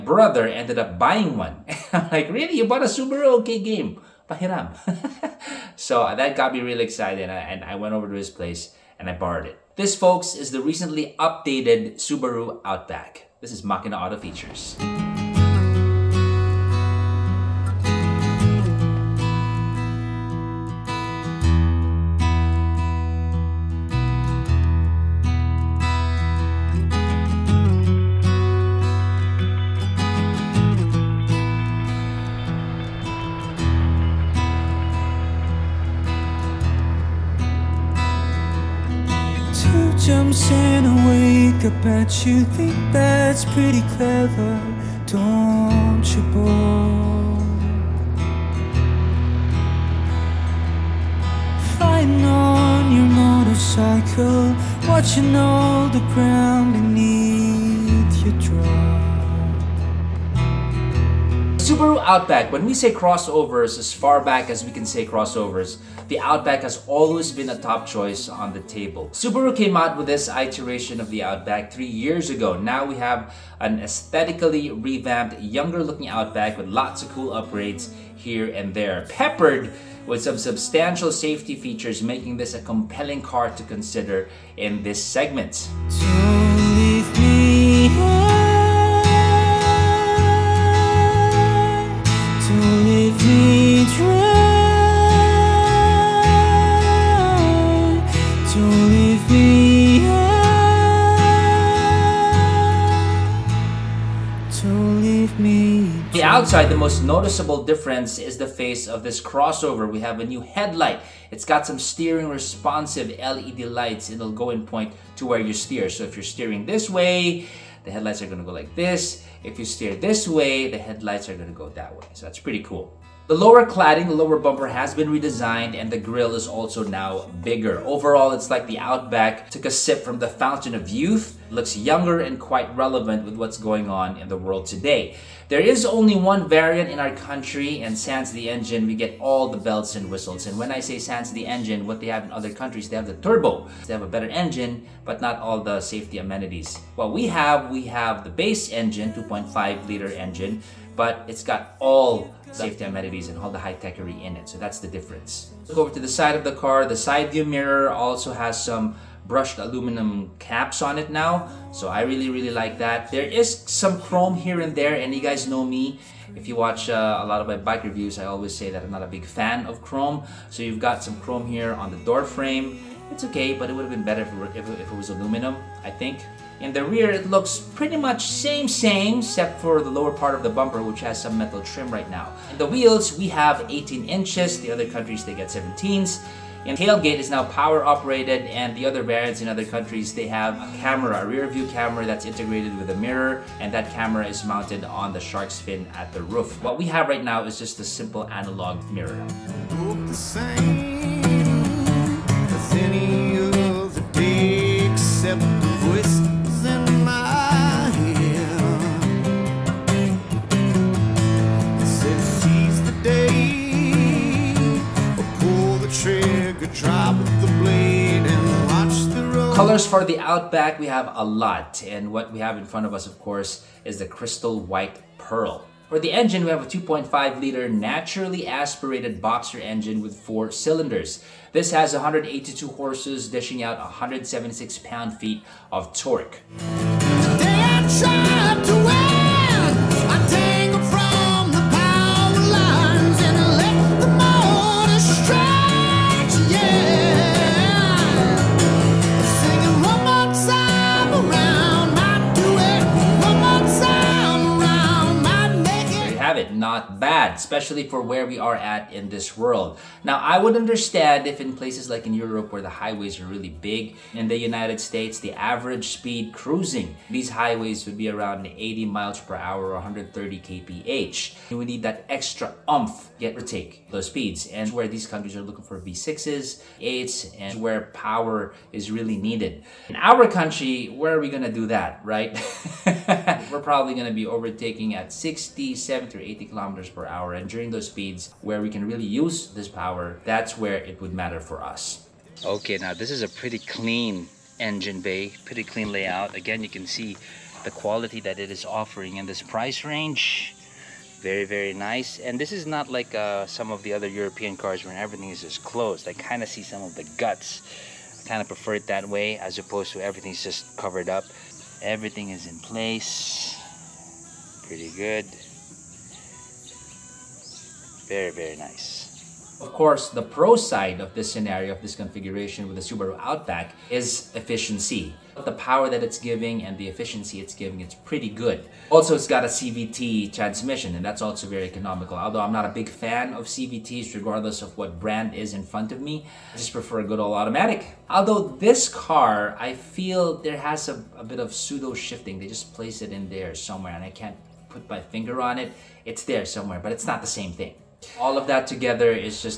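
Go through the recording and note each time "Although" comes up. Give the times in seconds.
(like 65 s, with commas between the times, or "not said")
332 s, 338 s.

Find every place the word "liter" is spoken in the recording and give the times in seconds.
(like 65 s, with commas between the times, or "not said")
149 s, 227 s.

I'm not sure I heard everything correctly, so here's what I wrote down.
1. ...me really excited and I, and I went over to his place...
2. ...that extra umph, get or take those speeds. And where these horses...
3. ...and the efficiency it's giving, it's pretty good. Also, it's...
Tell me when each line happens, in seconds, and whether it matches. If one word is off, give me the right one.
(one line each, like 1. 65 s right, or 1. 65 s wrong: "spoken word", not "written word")
1. 6 s right
2. 271 s wrong: "countries", not "horses"
3. 326 s right.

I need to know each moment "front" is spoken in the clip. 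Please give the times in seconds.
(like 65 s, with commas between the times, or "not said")
222 s, 335 s.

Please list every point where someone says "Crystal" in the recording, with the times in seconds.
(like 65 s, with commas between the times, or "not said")
224 s.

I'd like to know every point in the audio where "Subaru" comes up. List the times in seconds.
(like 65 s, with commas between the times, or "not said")
2 s, 11 s, 61 s, 69 s, 322 s.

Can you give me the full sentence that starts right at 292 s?
Okay, now this is a pretty clean engine bay, pretty clean layout.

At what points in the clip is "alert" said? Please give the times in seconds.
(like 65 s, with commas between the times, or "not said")
not said.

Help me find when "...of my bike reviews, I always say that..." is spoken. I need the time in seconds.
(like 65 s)
167 s.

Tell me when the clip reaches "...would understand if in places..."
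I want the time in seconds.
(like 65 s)
260 s.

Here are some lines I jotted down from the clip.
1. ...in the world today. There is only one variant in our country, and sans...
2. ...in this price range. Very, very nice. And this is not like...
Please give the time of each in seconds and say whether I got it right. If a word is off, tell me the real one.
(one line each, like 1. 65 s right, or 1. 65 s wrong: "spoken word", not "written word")
1. 134 s right
2. 299 s right.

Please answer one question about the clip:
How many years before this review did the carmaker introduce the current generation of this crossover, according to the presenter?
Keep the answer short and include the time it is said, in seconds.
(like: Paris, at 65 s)
3, at 71 s.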